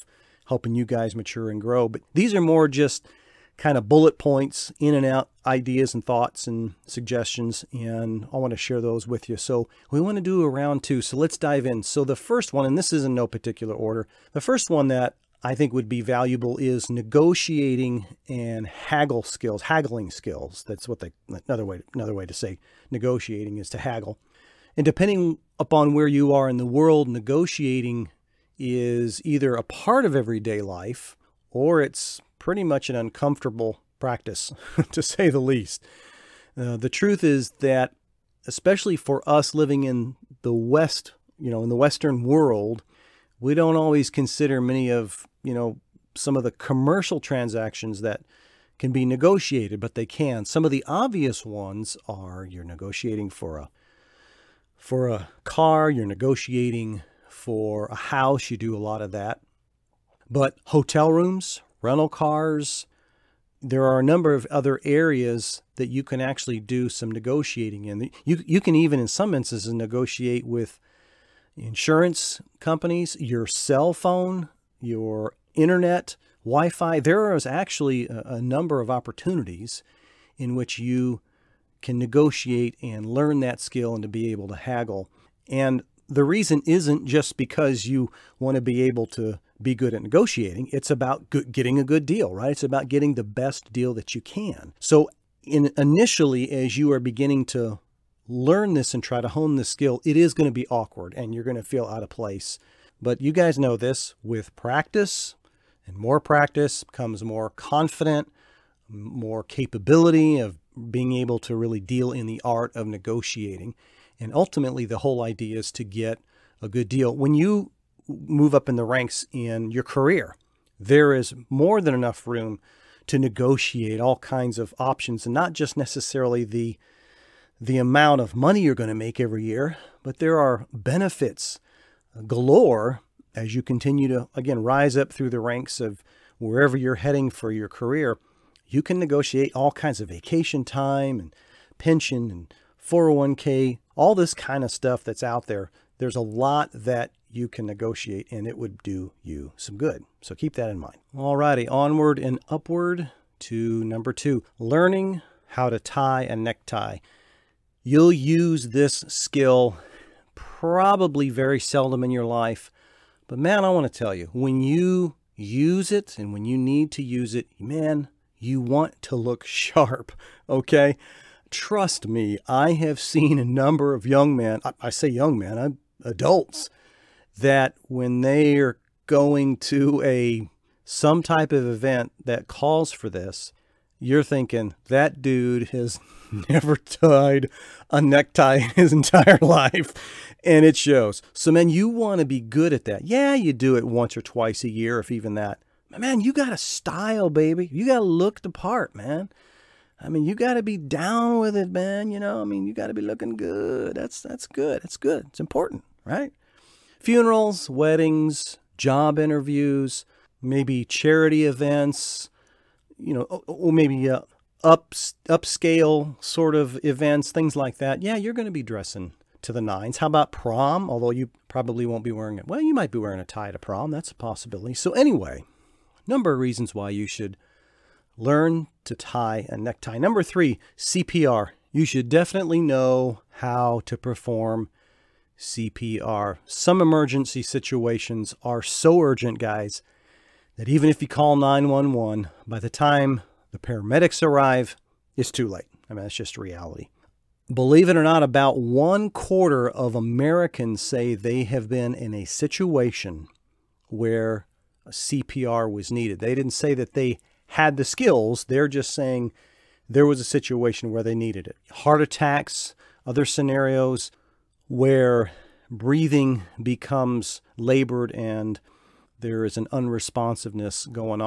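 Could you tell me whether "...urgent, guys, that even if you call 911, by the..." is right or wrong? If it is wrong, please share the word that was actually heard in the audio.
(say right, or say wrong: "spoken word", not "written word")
right.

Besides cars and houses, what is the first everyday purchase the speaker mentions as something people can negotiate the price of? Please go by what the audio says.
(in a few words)
Hotel rooms.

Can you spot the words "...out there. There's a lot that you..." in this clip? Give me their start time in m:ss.
2:25.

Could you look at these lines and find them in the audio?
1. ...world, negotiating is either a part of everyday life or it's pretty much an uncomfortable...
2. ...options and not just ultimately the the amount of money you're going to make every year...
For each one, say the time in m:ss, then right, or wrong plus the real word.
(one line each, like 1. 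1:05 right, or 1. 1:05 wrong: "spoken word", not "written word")
1. 0:26 right
2. 2:04 wrong: "necessarily", not "ultimately".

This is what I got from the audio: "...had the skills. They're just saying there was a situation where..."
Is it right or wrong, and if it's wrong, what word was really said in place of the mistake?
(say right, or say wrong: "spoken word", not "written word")
right.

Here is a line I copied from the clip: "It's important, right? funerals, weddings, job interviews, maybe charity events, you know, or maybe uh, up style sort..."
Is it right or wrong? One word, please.
wrong.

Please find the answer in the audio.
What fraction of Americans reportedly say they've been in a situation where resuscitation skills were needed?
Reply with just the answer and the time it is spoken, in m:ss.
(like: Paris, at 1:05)
One quarter, at 4:08.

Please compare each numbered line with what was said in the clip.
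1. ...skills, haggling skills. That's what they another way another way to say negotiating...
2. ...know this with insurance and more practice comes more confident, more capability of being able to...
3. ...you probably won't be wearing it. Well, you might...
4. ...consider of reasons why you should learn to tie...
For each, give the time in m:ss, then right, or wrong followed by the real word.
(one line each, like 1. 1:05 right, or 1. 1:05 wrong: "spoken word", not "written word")
1. 0:19 right
2. 1:43 wrong: "practice", not "insurance"
3. 3:41 right
4. 3:46 wrong: "number", not "consider".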